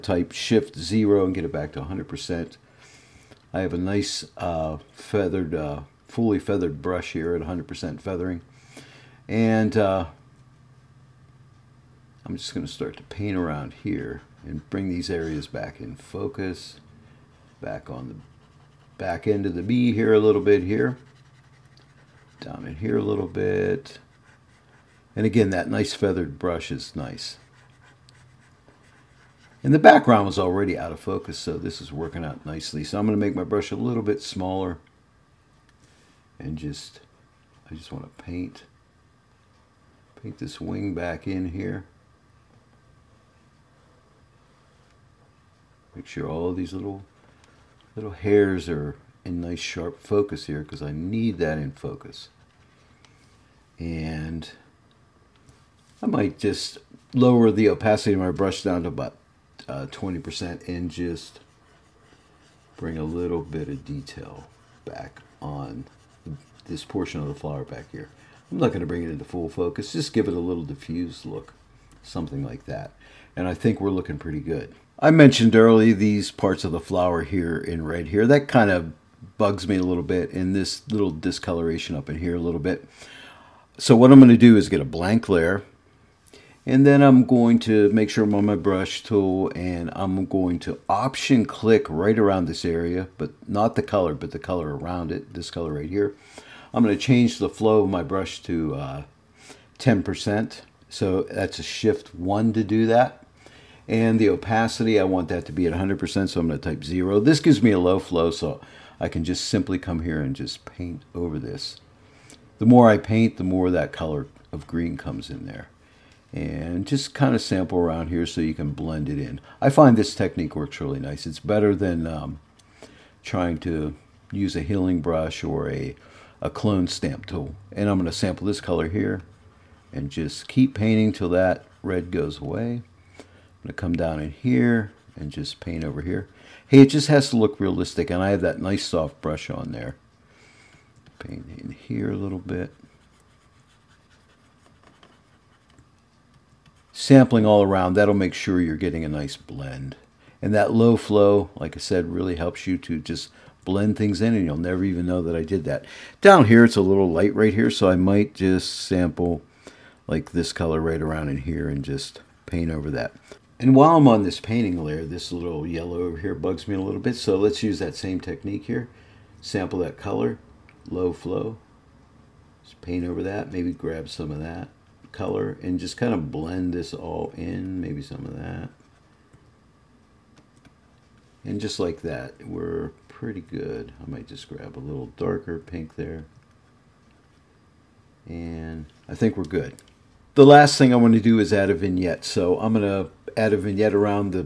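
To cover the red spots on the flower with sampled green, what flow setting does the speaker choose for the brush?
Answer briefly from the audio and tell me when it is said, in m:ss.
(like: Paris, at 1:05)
10%, at 1:39.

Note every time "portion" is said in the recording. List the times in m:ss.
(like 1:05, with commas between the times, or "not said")
1:06.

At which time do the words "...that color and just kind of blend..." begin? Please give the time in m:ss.
2:54.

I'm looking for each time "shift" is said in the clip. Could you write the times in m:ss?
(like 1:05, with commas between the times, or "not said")
0:00, 1:41.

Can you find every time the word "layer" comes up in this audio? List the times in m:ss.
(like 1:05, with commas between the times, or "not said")
1:25, 2:44.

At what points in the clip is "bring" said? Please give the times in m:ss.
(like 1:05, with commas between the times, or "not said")
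0:14, 1:02, 1:08.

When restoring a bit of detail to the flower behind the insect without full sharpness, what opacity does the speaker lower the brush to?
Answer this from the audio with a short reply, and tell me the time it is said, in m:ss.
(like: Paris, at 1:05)
20%, at 0:59.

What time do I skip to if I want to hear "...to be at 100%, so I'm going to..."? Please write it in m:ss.
1:45.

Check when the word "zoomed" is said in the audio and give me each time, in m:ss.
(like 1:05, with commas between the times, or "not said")
not said.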